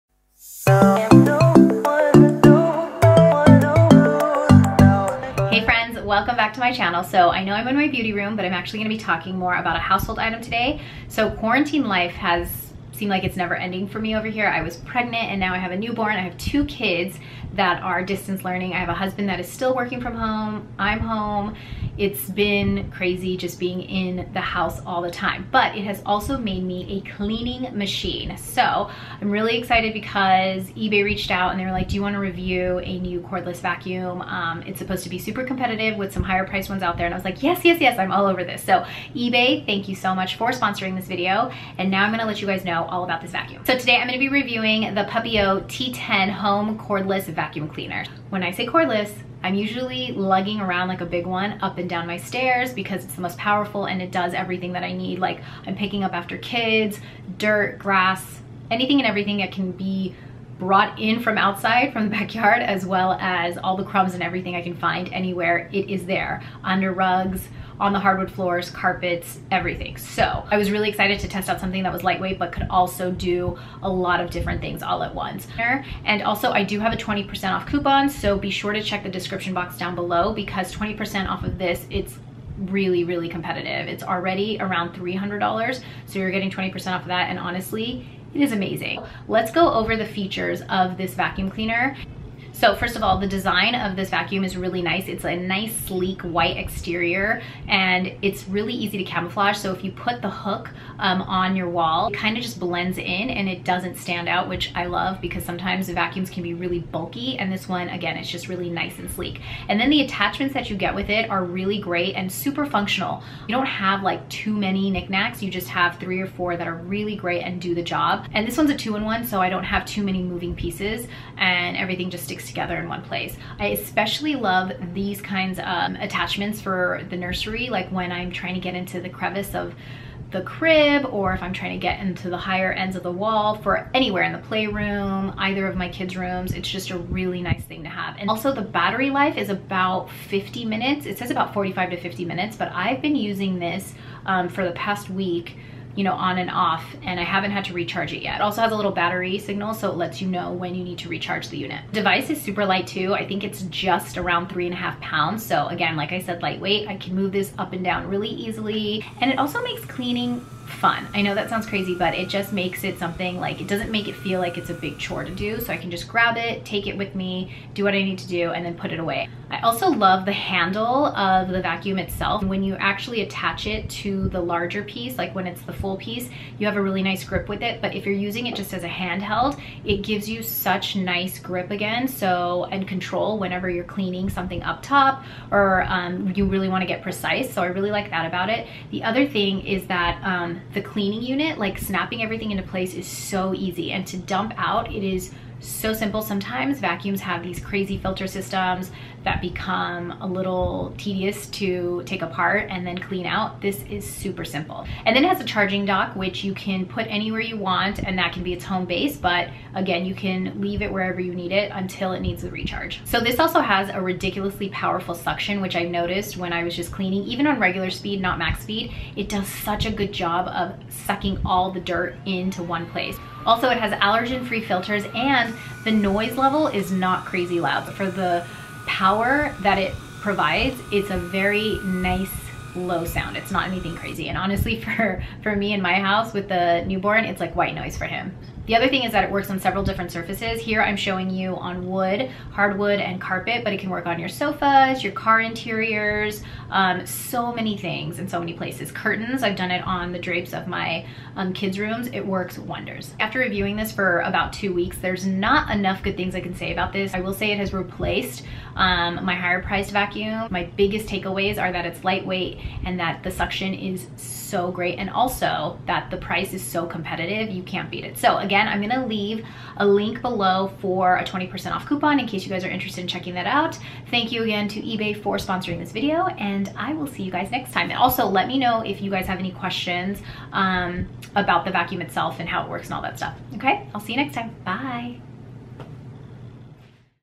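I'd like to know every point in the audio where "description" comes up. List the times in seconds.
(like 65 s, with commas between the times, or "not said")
79 s.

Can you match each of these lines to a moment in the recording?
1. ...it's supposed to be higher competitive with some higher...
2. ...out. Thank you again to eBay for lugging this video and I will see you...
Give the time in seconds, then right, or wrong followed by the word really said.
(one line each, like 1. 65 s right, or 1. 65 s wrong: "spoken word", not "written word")
1. 34 s wrong: "super", not "higher"
2. 273 s wrong: "sponsoring", not "lugging".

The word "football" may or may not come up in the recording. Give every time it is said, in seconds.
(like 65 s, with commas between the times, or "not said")
not said.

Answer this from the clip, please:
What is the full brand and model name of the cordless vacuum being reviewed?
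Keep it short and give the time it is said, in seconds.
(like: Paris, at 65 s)
Puppyoo T10, at 45 s.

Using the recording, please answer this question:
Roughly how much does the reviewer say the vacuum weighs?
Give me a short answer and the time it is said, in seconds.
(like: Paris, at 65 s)
3.5 pounds, at 154 s.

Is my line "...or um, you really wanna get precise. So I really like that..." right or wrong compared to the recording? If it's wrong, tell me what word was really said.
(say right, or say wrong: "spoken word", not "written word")
right.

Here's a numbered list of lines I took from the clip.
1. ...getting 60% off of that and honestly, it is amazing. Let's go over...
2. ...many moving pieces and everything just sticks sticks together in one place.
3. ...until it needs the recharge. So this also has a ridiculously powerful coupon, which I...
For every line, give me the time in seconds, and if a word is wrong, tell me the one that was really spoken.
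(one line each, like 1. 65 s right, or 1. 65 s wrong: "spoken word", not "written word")
1. 86 s wrong: "20", not "60"
2. 120 s right
3. 211 s wrong: "suction", not "coupon".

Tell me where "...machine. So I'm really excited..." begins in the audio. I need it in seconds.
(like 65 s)
27 s.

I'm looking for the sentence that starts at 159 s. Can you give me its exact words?
And it also makes cleaning fun.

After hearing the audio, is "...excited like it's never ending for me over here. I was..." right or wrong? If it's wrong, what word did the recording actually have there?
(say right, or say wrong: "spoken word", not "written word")
wrong: "seemed", not "excited".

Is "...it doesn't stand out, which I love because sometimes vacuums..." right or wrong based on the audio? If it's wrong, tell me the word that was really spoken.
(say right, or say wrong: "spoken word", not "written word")
right.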